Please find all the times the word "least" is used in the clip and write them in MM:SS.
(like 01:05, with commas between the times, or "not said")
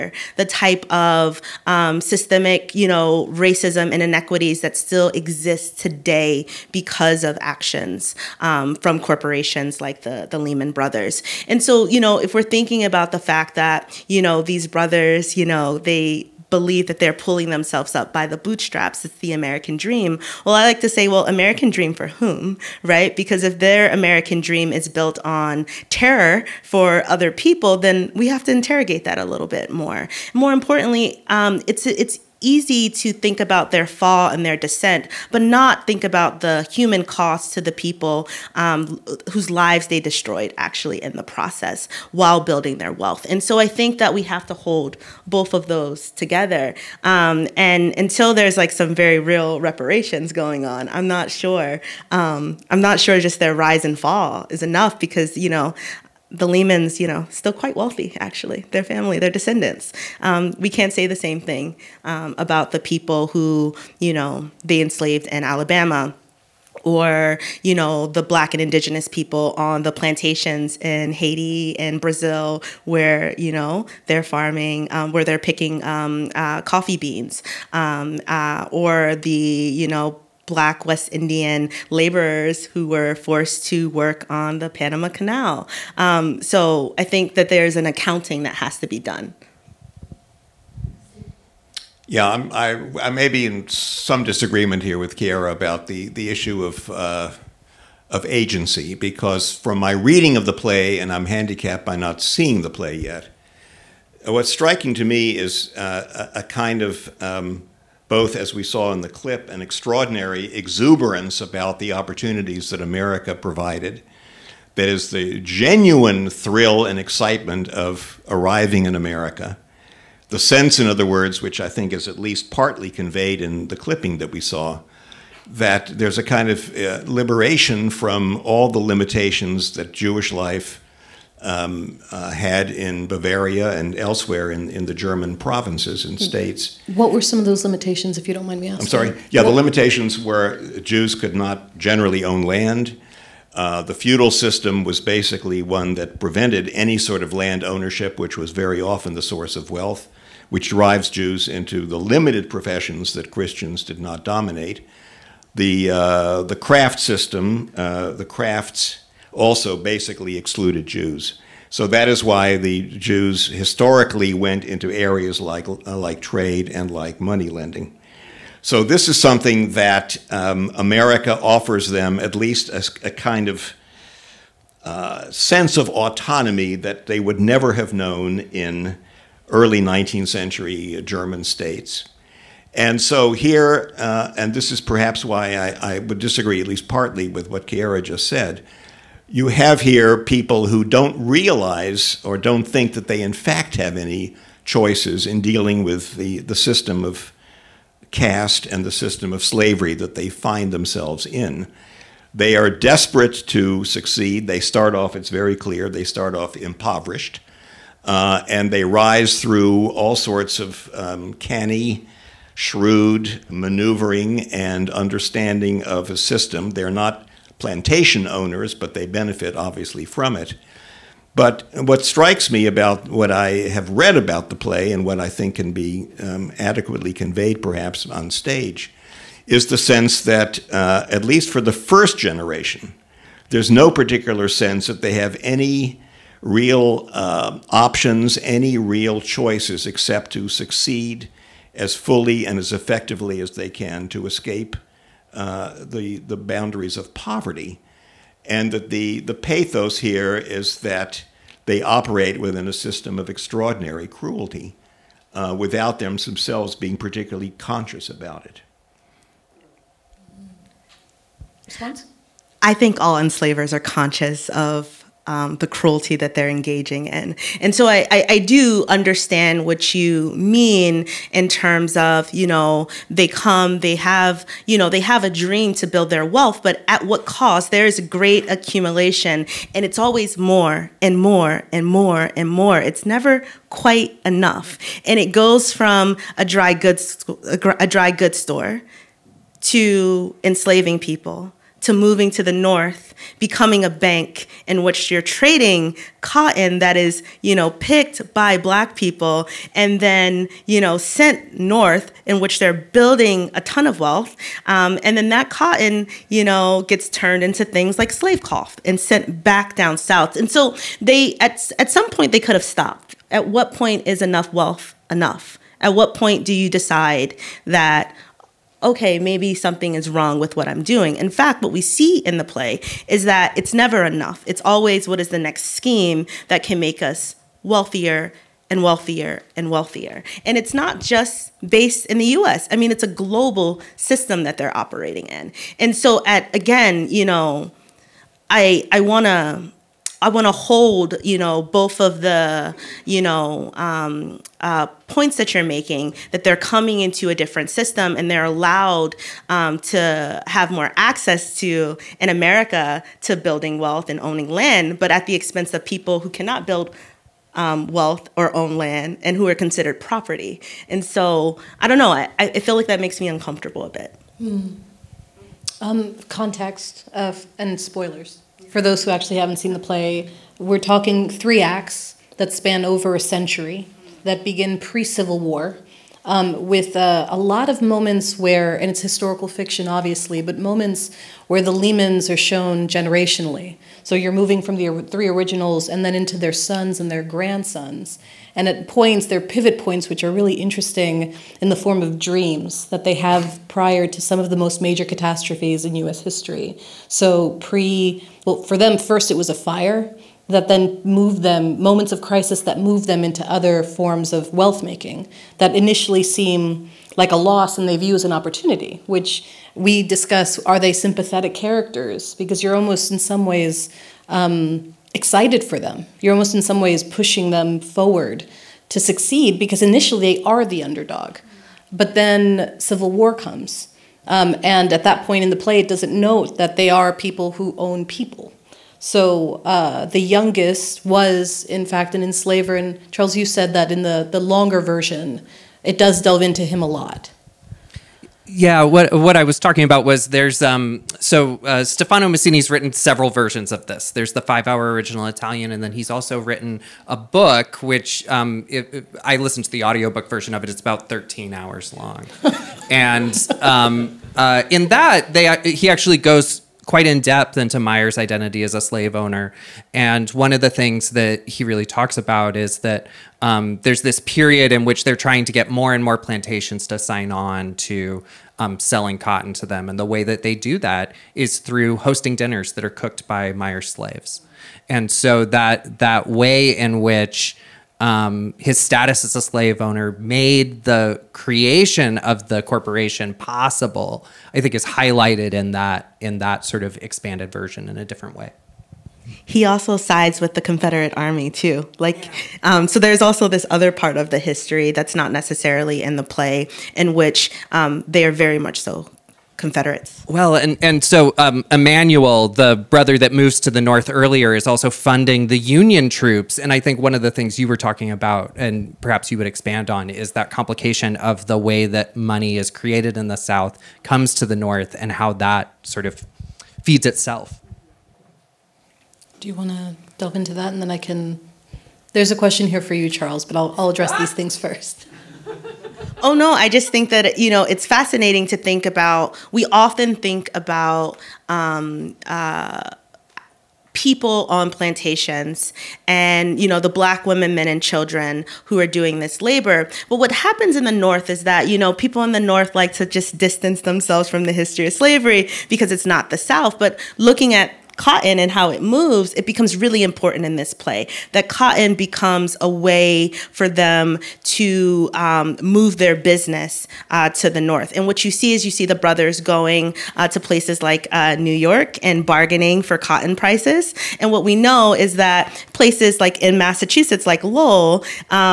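02:02, 02:52, 03:06, 03:51.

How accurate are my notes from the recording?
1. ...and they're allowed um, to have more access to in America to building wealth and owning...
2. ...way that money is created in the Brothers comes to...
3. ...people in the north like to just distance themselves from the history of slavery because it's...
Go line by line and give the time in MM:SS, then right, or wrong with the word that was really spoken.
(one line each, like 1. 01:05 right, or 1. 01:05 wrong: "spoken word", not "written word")
1. 05:48 right
2. 08:31 wrong: "South", not "Brothers"
3. 09:01 right.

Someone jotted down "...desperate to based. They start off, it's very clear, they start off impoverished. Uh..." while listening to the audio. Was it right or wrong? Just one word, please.
wrong.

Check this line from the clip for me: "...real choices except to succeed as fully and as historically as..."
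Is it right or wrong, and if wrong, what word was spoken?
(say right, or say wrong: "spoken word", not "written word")
wrong: "effectively", not "historically".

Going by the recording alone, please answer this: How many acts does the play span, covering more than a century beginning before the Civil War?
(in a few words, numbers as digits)
3.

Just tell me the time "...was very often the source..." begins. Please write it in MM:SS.
02:28.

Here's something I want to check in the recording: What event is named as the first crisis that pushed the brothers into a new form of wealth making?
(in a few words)
A fire.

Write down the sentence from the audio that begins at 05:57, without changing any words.
Um, wealth or own land and who are considered property.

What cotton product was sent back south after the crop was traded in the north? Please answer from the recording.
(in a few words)
Slave cloth.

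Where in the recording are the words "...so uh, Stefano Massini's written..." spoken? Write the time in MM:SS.
07:21.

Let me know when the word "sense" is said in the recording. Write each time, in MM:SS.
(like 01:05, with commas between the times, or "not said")
02:00, 02:55, 03:49, 03:54.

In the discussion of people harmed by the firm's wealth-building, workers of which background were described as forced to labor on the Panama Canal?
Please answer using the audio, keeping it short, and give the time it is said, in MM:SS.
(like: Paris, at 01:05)
Black West Indian, at 01:20.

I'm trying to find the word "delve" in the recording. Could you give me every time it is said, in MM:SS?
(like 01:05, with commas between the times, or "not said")
07:16, 08:40.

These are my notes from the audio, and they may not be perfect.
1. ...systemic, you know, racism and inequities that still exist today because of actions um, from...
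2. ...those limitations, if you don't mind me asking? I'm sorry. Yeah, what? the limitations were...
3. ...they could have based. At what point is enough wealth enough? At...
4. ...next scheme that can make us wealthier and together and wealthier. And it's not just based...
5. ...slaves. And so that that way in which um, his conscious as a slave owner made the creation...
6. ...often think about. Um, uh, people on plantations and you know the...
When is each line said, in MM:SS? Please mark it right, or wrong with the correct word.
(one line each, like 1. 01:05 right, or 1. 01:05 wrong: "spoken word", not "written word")
1. 00:02 right
2. 02:17 right
3. 05:12 wrong: "stopped", not "based"
4. 05:25 wrong: "wealthier", not "together"
5. 07:53 wrong: "status", not "conscious"
6. 08:49 right.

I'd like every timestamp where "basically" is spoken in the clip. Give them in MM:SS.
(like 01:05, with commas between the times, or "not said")
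02:24, 02:39.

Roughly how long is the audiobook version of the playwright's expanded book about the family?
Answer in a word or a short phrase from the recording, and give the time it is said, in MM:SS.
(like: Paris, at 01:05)
13 hours, at 07:31.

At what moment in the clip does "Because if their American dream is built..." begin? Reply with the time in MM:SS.
00:23.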